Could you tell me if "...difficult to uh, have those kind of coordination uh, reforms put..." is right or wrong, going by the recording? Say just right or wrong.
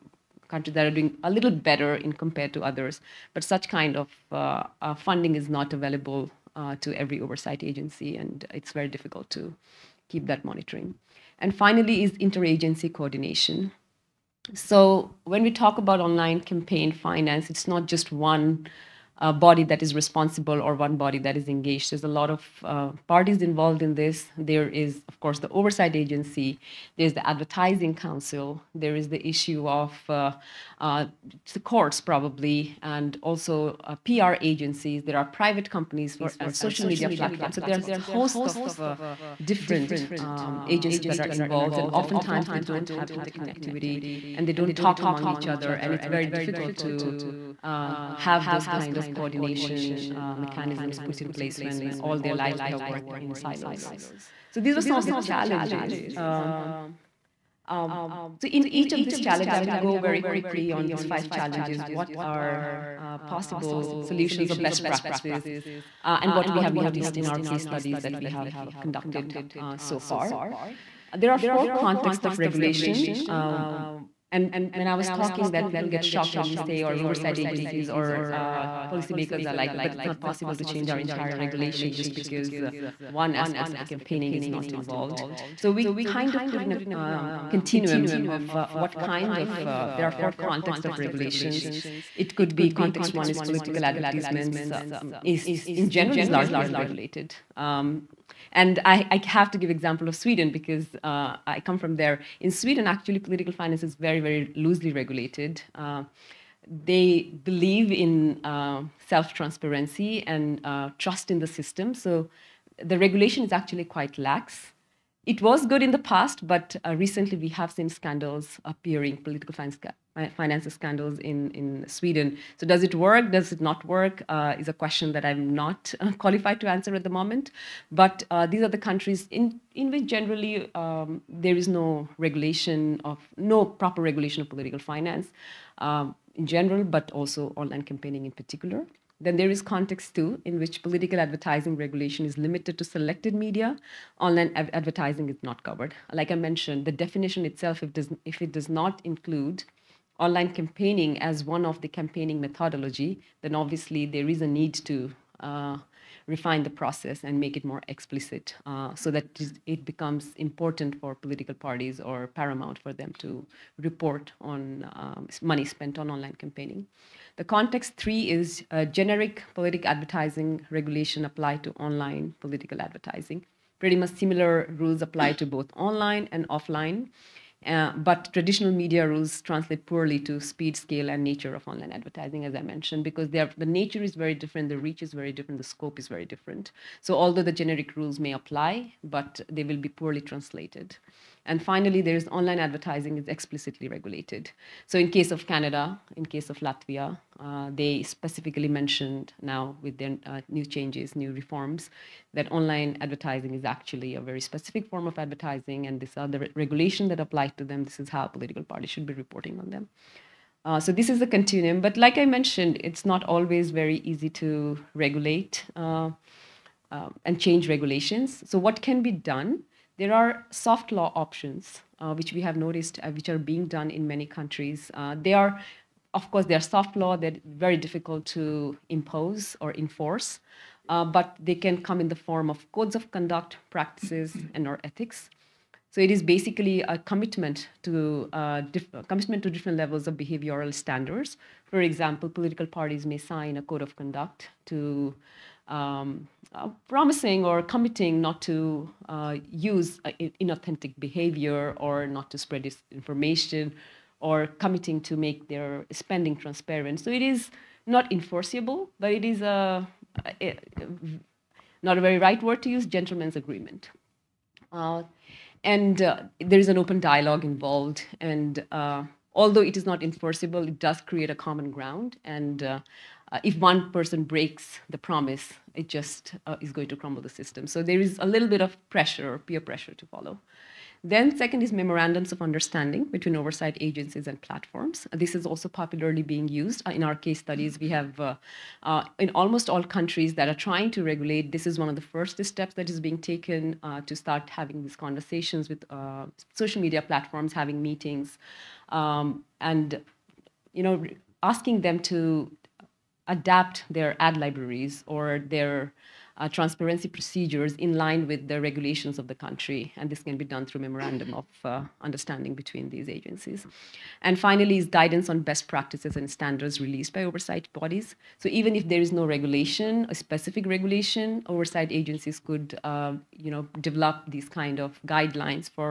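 wrong.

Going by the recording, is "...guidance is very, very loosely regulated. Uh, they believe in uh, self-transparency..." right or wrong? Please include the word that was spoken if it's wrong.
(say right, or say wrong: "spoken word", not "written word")
wrong: "finance", not "guidance".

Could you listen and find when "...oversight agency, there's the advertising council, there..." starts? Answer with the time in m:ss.
0:25.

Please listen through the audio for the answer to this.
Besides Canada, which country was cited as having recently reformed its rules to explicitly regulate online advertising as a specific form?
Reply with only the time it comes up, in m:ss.
3:16.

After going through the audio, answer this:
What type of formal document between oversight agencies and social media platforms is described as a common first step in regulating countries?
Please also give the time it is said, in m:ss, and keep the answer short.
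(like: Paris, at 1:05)
Memorandums of understanding, at 4:41.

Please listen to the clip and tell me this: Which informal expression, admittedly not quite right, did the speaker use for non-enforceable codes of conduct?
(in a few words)
gentleman's agreement.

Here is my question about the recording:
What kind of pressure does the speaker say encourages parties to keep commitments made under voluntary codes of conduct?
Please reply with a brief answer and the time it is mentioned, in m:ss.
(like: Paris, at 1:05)
peer pressure, at 4:39.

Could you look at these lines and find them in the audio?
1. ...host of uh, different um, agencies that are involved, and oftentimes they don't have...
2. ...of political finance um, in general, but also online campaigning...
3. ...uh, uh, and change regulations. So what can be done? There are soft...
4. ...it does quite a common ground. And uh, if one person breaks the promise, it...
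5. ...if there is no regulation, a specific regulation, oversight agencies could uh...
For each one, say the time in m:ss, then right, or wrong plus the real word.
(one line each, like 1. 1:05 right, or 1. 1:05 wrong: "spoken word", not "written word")
1. 0:37 right
2. 2:14 right
3. 3:35 right
4. 4:30 wrong: "create", not "quite"
5. 5:18 right.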